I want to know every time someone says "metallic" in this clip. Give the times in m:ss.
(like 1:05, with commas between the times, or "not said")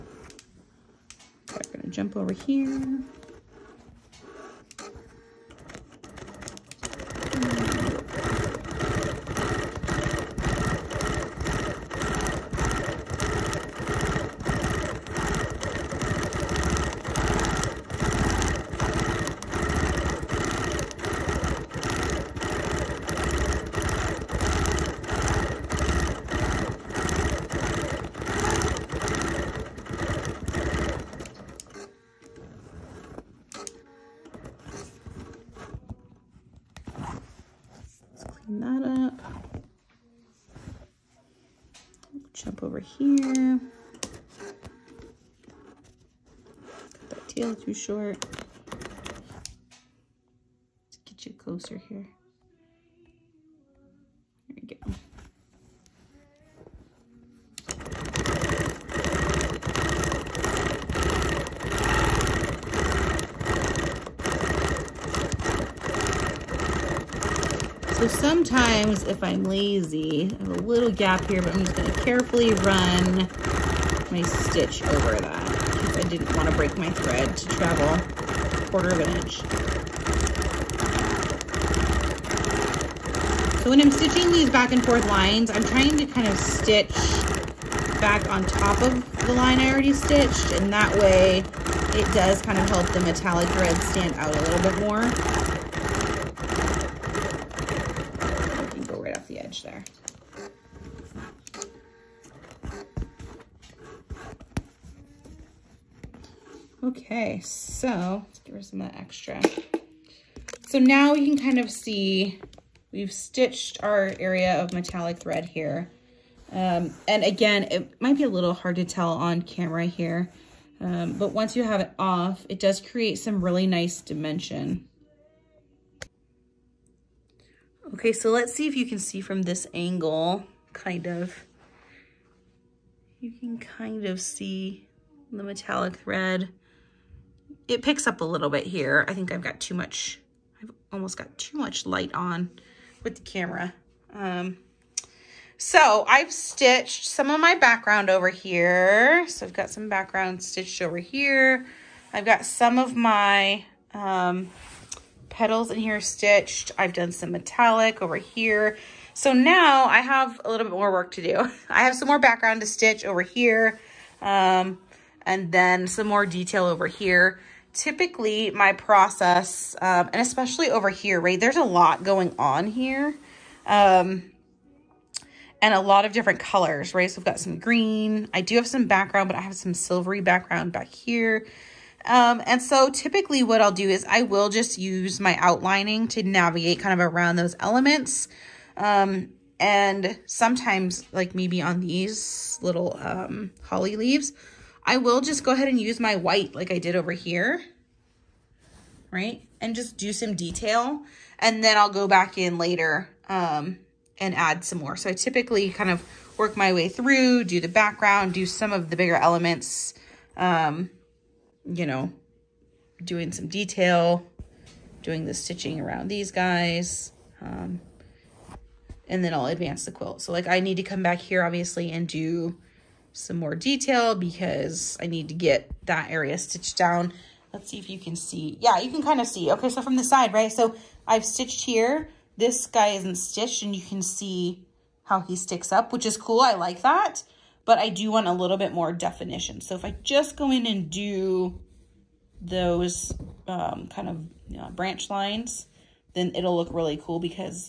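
1:33, 1:54, 2:15, 2:37.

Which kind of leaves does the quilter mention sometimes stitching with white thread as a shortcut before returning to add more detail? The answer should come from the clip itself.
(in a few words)
holly leaves.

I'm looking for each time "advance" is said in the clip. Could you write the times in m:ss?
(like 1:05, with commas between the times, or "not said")
3:39.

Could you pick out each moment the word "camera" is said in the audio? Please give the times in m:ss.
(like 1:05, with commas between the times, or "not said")
1:59, 2:23.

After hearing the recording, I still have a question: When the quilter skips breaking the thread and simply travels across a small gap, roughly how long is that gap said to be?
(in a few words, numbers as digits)
a quarter of an inch.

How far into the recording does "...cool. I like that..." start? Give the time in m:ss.
3:56.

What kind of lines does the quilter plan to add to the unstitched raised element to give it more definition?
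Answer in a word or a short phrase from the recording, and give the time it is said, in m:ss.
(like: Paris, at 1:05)
branch lines, at 4:04.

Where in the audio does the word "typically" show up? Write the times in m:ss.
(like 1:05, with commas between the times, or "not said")
2:47, 3:02, 3:25.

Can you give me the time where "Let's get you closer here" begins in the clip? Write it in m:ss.
0:50.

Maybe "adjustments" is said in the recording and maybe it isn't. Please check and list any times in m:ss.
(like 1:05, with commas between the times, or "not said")
not said.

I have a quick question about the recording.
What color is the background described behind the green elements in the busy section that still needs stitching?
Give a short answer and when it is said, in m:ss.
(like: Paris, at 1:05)
silvery, at 2:59.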